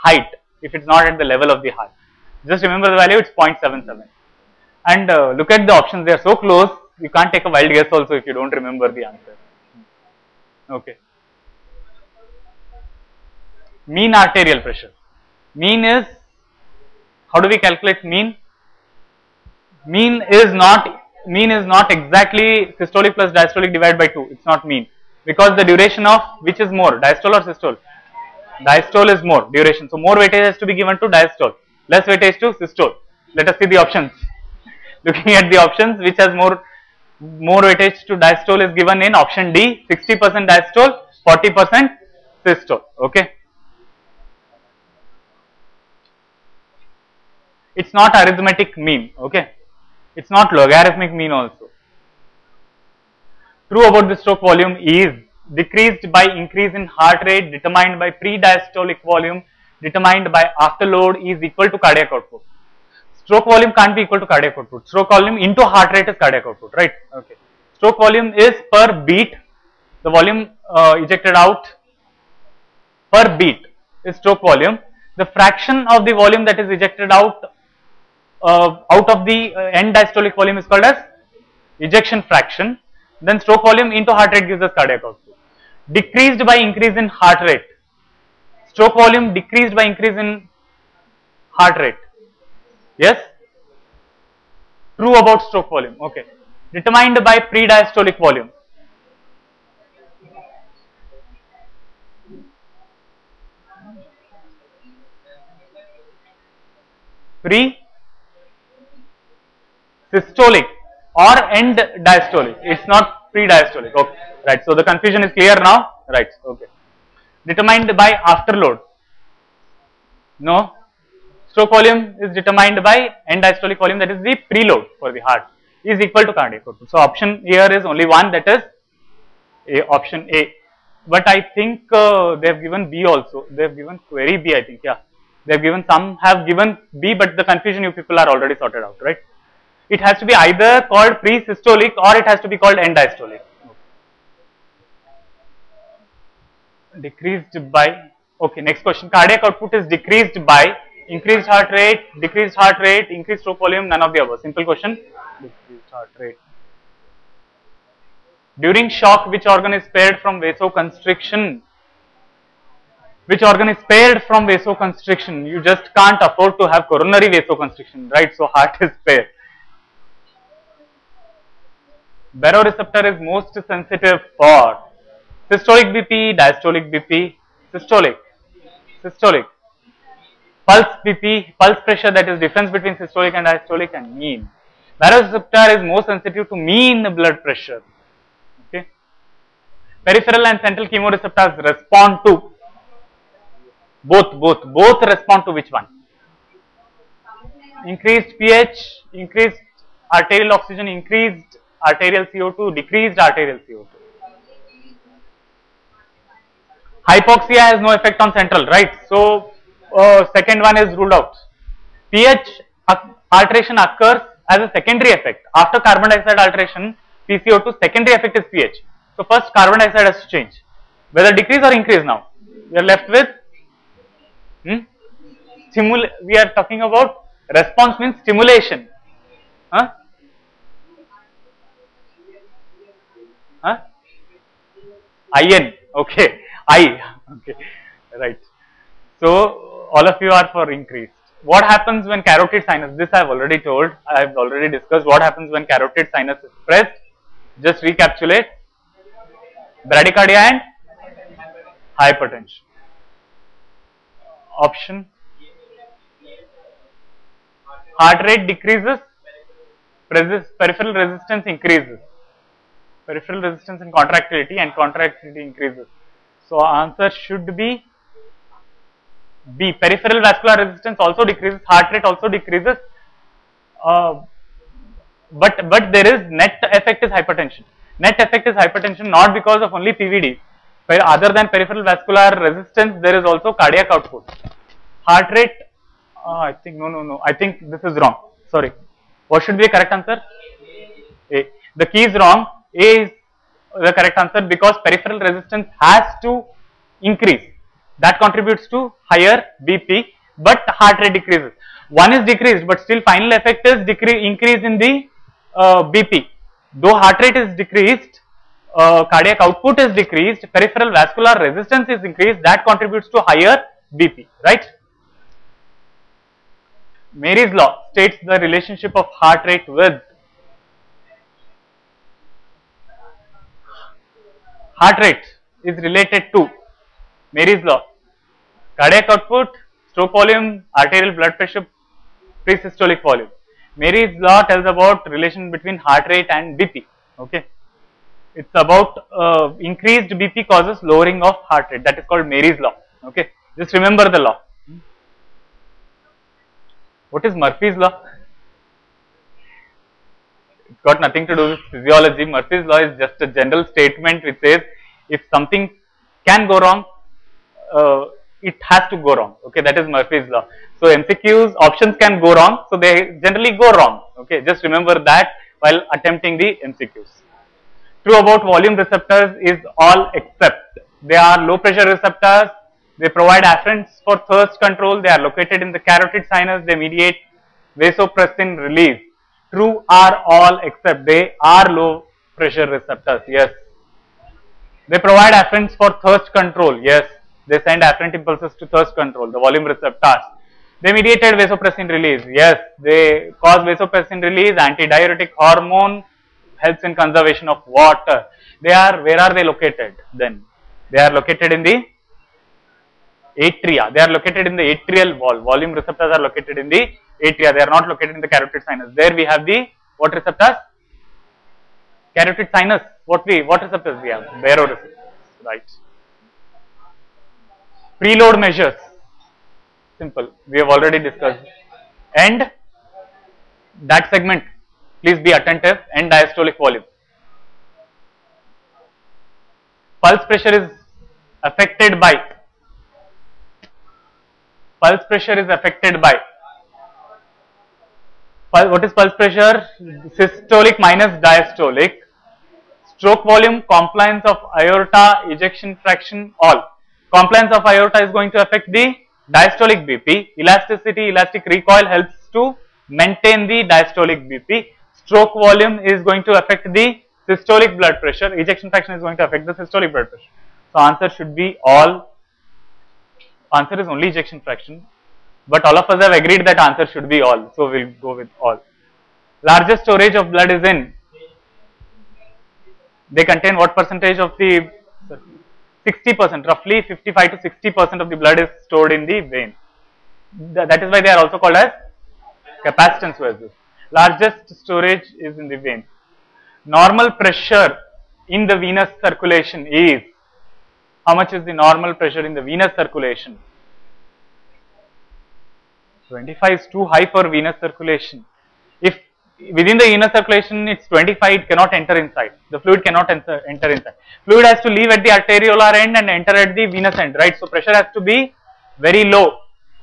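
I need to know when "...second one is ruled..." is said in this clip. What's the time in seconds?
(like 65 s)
210 s.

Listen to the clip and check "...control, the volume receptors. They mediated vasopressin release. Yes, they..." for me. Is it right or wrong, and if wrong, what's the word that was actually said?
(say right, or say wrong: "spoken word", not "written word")
right.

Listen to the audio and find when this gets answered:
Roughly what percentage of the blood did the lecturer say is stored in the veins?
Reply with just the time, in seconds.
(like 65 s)
476 s.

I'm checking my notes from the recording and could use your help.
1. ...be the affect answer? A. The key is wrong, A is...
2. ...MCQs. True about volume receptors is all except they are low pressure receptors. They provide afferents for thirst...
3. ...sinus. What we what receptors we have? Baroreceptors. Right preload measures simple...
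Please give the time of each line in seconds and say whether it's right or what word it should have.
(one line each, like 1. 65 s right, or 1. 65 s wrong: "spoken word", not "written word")
1. 289 s wrong: "correct", not "affect"
2. 366 s right
3. 412 s right.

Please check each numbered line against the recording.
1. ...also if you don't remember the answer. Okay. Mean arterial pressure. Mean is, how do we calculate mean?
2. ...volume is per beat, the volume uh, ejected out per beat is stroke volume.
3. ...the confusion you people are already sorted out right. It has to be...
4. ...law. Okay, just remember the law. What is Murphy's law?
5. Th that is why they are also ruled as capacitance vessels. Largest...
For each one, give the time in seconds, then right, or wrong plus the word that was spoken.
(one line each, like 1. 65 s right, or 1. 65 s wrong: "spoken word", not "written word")
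1. 7 s right
2. 67 s right
3. 137 s right
4. 342 s right
5. 480 s wrong: "called", not "ruled".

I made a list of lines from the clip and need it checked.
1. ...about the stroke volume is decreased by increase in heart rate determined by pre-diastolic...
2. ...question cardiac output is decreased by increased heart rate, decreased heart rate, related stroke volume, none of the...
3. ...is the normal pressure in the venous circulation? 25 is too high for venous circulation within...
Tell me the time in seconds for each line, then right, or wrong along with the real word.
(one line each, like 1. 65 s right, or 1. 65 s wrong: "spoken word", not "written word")
1. 53 s right
2. 148 s wrong: "increased", not "related"
3. 491 s right.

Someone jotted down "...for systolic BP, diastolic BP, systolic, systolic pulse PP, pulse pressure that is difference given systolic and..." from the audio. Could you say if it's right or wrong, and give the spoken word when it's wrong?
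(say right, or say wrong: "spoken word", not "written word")
wrong: "between", not "given".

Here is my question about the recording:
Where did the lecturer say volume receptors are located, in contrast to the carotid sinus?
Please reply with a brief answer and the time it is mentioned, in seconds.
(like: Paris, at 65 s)
Atrial wall, at 404 s.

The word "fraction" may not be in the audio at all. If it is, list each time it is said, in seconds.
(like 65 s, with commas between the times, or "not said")
75 s, 82 s, 445 s, 458 s, 464 s.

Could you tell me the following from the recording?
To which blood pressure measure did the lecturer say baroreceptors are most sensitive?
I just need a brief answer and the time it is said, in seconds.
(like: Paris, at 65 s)
Mean blood pressure, at 186 s.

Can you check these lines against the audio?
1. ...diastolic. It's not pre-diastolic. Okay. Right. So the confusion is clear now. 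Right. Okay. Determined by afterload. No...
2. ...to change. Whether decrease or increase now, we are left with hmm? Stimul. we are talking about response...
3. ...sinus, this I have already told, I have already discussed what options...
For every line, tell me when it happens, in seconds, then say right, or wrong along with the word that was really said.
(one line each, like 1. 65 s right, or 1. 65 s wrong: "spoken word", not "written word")
1. 112 s right
2. 220 s right
3. 242 s wrong: "happens", not "options".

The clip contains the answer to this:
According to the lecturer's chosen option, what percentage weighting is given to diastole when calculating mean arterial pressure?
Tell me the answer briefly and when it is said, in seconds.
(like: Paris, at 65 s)
60 percent, at 39 s.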